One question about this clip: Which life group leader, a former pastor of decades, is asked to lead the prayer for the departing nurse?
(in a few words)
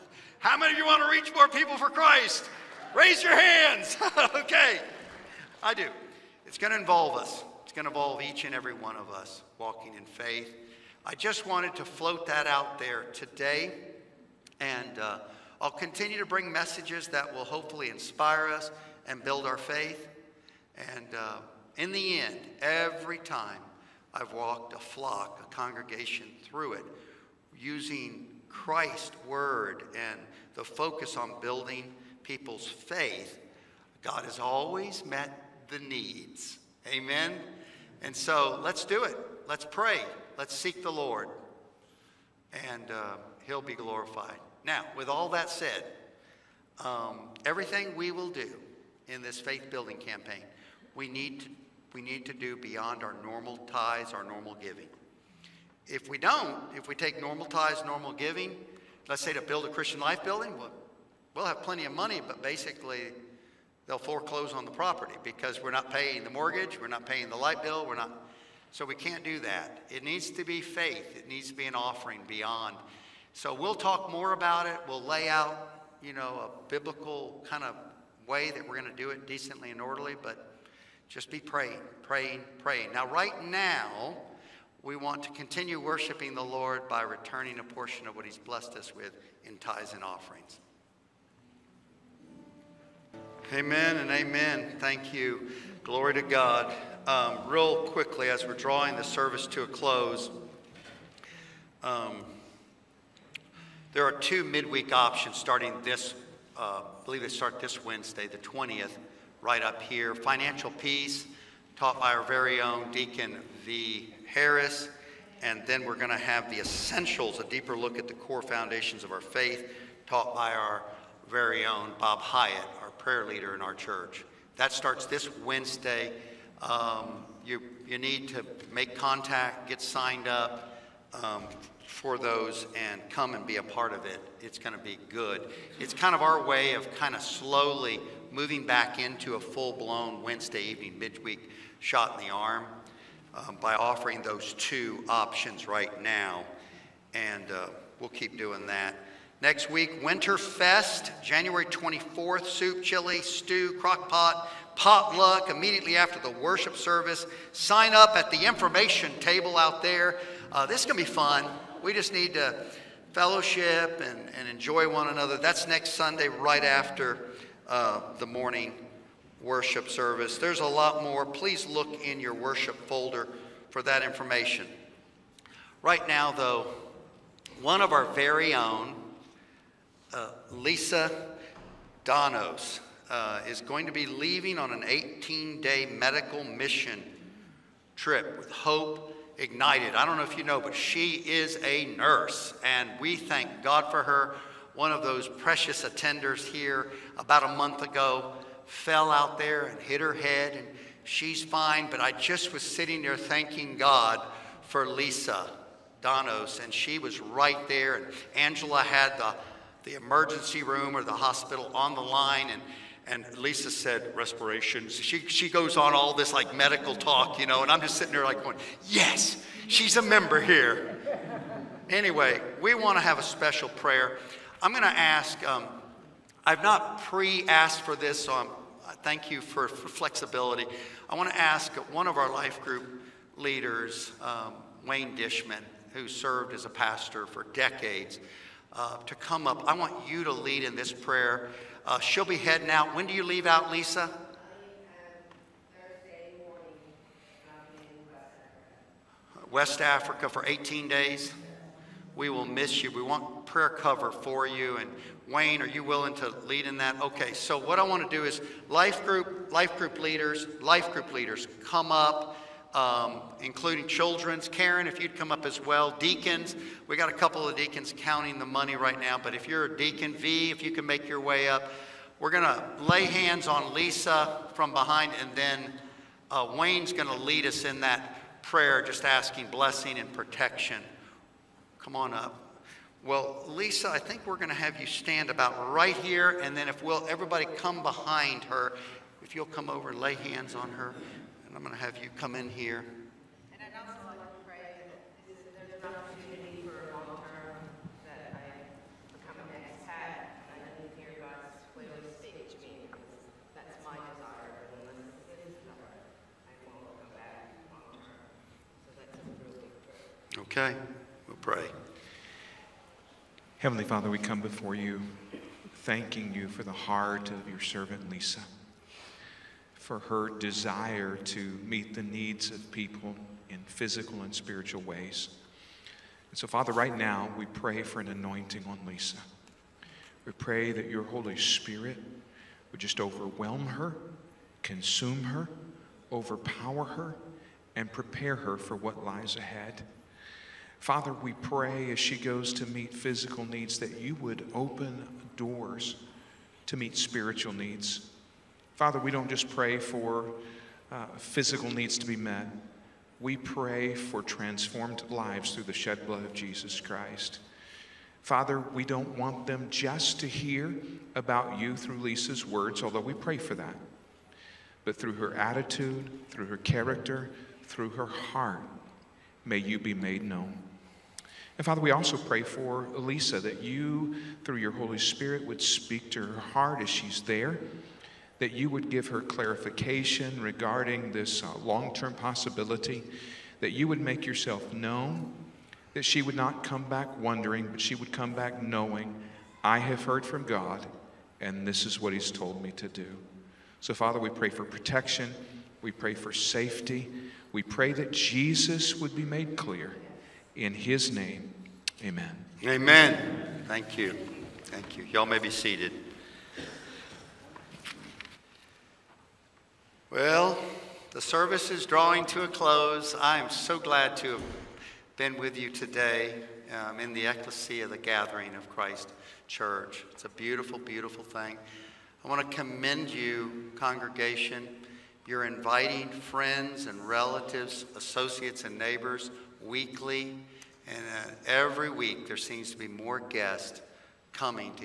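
Wayne Dishman.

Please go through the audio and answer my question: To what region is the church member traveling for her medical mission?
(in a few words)
West Africa.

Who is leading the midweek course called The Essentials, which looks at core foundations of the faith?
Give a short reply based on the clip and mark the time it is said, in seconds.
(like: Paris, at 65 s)
Bob Hyatt, at 121 s.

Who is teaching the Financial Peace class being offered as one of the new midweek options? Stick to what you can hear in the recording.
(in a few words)
Deacon V. Harris.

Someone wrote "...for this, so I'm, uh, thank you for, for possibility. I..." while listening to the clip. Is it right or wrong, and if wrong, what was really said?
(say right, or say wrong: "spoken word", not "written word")
wrong: "flexibility", not "possibility".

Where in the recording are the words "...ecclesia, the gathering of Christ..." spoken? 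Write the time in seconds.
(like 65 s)
417 s.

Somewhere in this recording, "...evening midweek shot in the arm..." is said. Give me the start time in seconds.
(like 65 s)
140 s.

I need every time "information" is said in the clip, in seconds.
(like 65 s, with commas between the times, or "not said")
158 s, 174 s.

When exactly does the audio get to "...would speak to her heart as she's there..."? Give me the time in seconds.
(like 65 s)
375 s.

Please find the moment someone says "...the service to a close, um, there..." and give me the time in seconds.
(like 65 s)
98 s.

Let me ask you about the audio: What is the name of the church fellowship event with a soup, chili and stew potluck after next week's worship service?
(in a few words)
Winterfest.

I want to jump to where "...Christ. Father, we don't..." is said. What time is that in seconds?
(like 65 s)
356 s.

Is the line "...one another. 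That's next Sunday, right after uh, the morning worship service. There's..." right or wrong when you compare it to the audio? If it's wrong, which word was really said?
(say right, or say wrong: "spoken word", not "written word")
right.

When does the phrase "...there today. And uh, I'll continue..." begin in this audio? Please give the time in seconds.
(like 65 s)
12 s.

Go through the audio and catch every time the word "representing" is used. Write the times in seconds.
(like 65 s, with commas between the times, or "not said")
not said.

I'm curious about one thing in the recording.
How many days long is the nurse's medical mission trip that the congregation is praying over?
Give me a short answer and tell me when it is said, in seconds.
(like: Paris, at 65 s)
18, at 184 s.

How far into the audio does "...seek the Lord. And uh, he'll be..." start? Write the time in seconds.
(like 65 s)
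40 s.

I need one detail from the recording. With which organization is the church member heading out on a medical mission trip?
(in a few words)
Hope Ignited.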